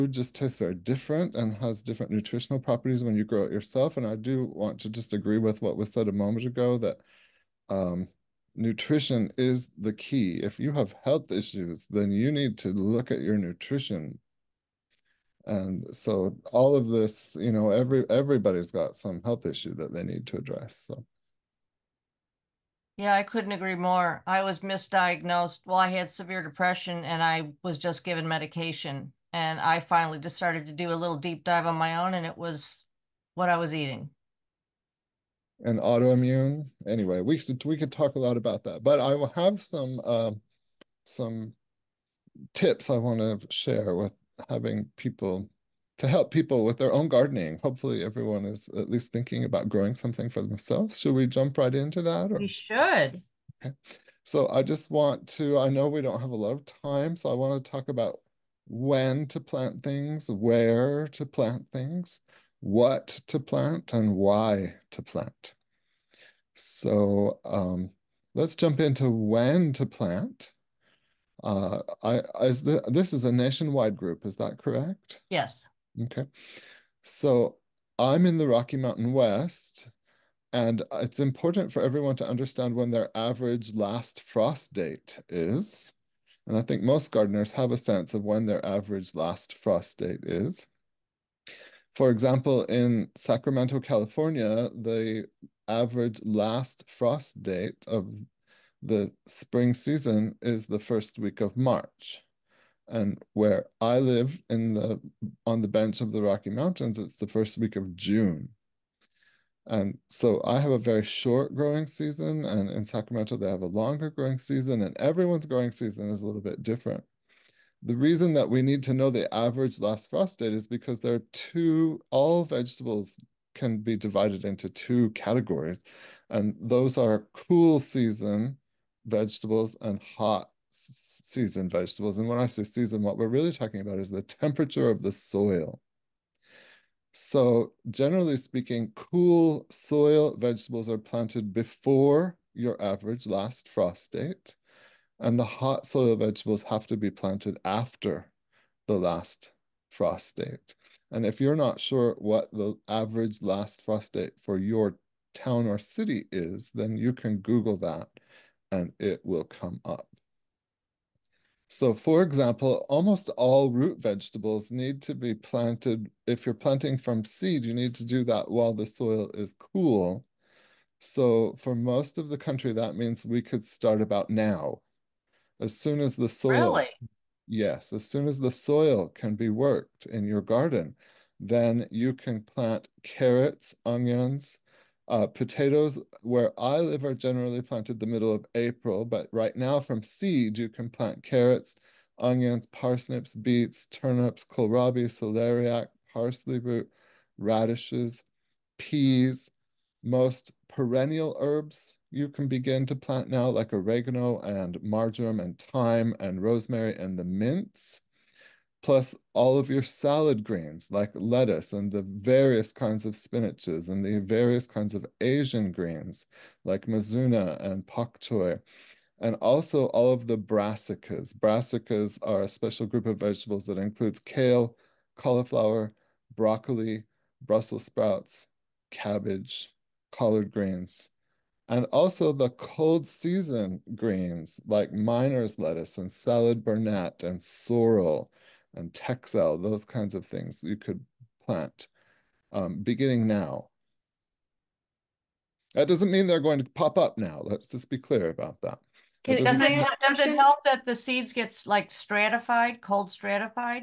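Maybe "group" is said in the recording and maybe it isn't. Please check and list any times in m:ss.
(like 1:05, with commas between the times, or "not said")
1:13, 3:42.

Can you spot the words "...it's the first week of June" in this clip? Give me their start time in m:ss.
1:46.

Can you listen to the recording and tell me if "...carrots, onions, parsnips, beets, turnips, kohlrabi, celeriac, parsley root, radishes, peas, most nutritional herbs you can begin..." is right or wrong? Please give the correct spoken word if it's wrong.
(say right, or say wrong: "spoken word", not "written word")
wrong: "perennial", not "nutritional".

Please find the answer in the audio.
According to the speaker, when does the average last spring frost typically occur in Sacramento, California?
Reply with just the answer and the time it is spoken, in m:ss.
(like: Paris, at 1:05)
First week of March, at 1:40.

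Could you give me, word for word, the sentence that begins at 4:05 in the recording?
That doesn't mean they're going to pop up now.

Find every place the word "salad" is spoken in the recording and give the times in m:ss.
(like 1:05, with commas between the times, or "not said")
3:29, 3:56.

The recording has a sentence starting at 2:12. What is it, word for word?
And when I say season, what we're really talking about is the temperature of the soil.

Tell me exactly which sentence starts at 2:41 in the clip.
So for example, almost all root vegetables need to be planted.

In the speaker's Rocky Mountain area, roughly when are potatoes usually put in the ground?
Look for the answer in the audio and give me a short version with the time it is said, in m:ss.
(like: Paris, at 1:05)
Middle of April, at 3:07.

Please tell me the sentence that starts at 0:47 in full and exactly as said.
Hopefully, everyone is at least thinking about growing something for themselves.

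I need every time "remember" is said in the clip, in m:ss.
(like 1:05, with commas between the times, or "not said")
not said.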